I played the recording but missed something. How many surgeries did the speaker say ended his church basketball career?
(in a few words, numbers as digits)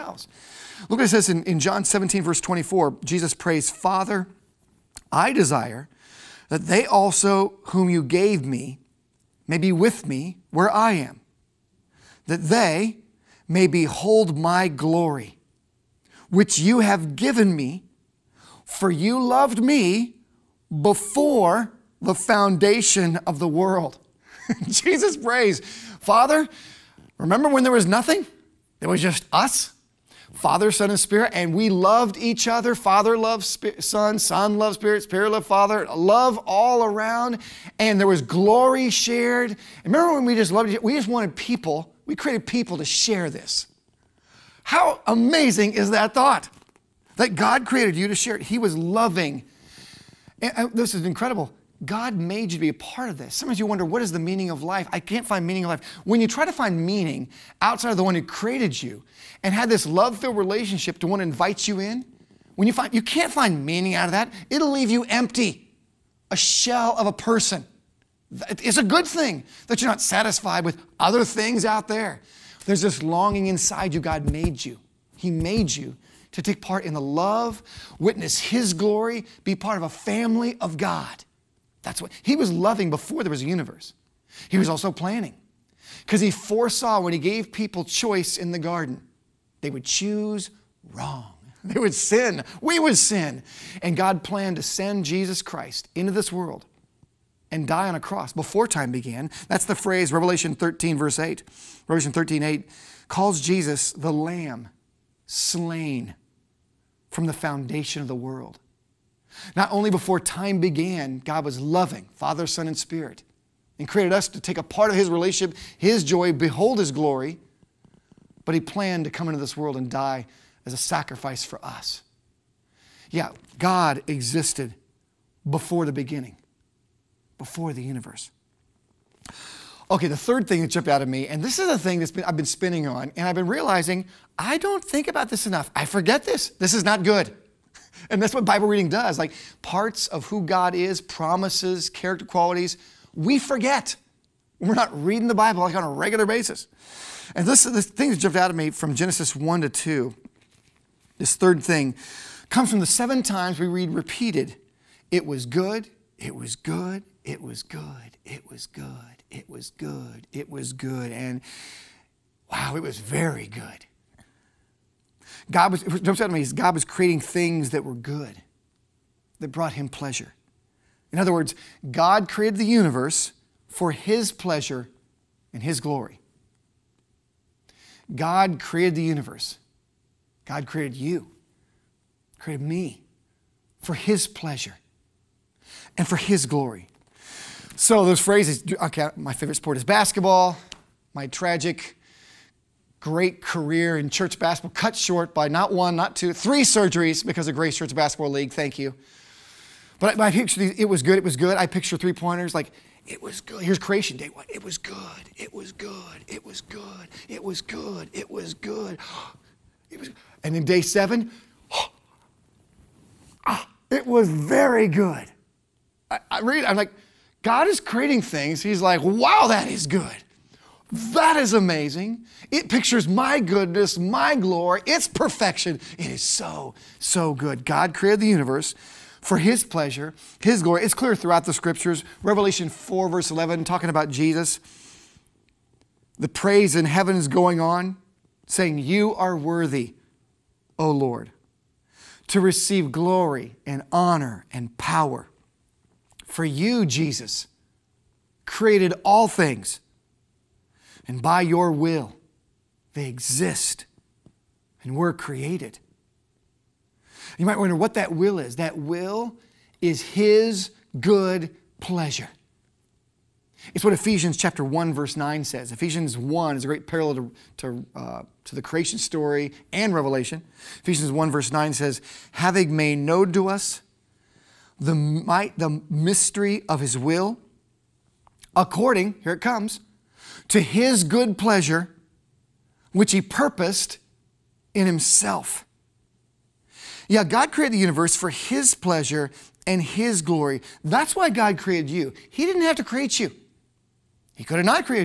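3.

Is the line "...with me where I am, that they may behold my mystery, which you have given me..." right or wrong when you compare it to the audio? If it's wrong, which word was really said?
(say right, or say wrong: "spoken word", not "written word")
wrong: "glory", not "mystery".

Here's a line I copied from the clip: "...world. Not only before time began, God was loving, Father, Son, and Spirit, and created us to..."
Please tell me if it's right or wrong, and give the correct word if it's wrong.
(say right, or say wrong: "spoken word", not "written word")
right.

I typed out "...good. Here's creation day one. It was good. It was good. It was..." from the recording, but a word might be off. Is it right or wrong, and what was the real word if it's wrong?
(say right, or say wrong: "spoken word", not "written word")
right.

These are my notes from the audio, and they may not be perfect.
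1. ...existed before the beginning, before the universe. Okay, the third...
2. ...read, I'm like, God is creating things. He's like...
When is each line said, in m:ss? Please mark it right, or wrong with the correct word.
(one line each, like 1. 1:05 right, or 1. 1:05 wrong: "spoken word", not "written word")
1. 2:04 right
2. 3:36 right.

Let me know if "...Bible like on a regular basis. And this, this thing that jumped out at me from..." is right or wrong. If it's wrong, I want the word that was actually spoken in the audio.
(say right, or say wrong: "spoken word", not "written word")
right.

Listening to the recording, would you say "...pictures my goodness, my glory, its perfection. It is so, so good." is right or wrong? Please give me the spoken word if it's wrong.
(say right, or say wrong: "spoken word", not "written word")
right.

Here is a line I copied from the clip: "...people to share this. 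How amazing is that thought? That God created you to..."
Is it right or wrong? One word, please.
right.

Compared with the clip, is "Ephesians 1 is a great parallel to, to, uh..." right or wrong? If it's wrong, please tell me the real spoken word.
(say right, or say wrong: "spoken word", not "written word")
right.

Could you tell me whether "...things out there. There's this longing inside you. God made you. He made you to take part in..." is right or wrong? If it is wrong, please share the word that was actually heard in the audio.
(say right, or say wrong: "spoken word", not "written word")
right.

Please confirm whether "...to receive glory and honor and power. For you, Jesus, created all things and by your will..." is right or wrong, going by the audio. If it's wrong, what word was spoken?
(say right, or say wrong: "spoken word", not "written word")
right.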